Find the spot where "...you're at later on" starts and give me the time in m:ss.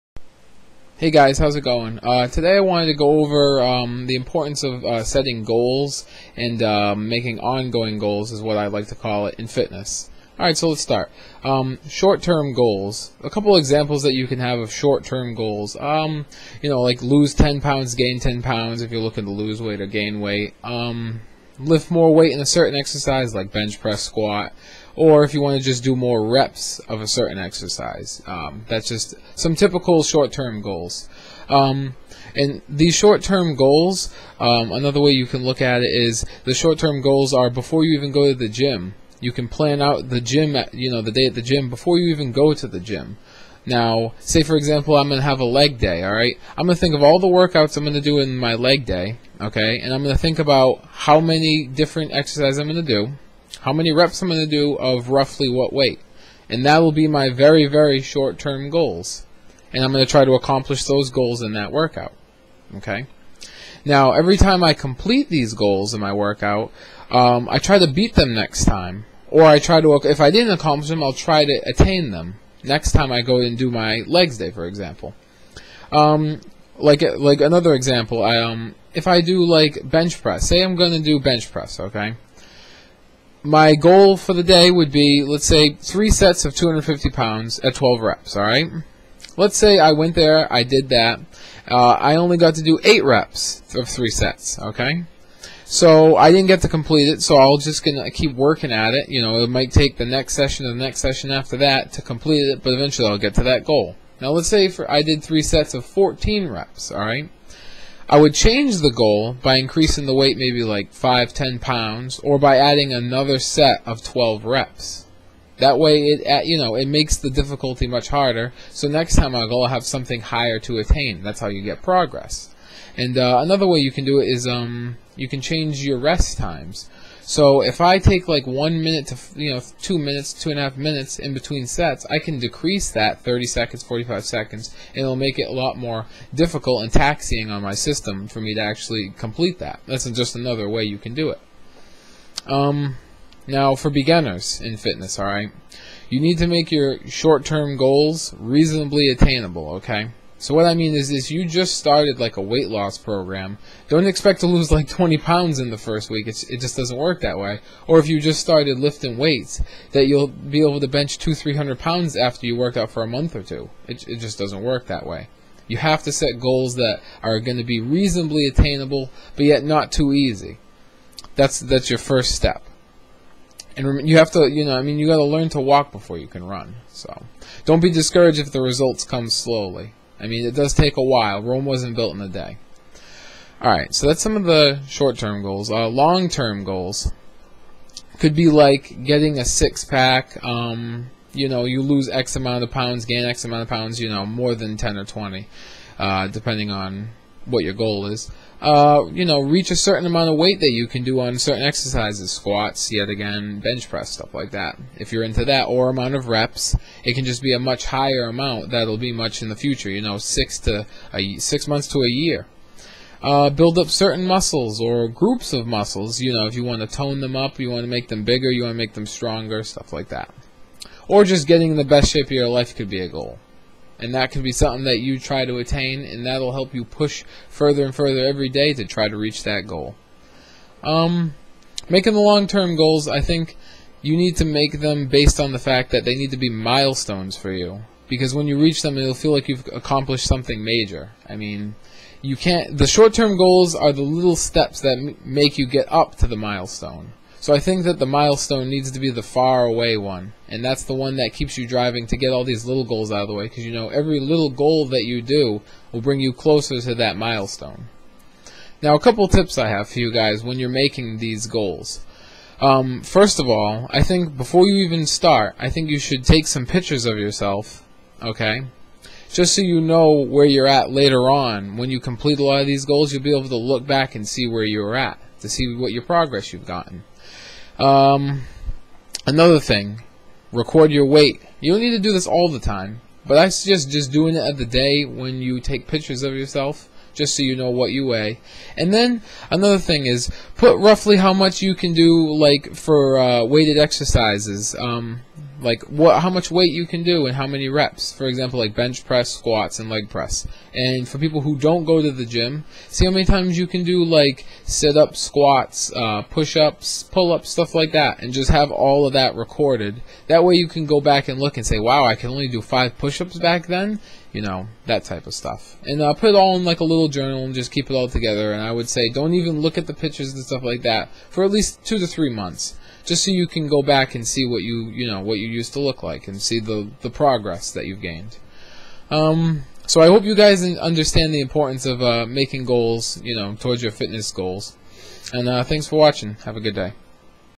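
4:30.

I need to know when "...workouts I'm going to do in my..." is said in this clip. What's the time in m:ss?
0:47.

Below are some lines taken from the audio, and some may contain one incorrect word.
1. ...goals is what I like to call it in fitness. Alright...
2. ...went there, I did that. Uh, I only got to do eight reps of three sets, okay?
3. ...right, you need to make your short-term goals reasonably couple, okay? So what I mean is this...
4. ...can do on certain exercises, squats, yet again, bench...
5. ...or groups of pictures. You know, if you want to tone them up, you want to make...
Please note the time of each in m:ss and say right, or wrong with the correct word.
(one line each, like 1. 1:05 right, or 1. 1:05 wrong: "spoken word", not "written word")
1. 0:07 right
2. 1:29 right
3. 2:25 wrong: "attainable", not "couple"
4. 3:20 right
5. 3:34 wrong: "muscles", not "pictures".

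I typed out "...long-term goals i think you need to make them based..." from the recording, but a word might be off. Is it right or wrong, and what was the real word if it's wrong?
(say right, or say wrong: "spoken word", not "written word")
right.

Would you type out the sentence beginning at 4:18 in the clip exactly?
Now, a couple tips I have for you guys when you're making these goals.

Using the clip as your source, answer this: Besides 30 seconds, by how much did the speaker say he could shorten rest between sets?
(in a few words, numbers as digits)
45 seconds.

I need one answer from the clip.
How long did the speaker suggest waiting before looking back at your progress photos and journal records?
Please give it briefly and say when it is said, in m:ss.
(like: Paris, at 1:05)
2 to 3 months, at 5:21.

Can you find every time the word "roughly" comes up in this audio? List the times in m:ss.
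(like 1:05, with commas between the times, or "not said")
0:55, 4:50.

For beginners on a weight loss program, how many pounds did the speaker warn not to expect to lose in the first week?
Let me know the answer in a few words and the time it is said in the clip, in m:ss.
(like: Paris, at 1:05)
20 pounds, at 2:34.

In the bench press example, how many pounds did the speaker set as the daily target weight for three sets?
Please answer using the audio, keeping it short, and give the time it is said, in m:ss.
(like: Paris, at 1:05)
250 pounds, at 1:26.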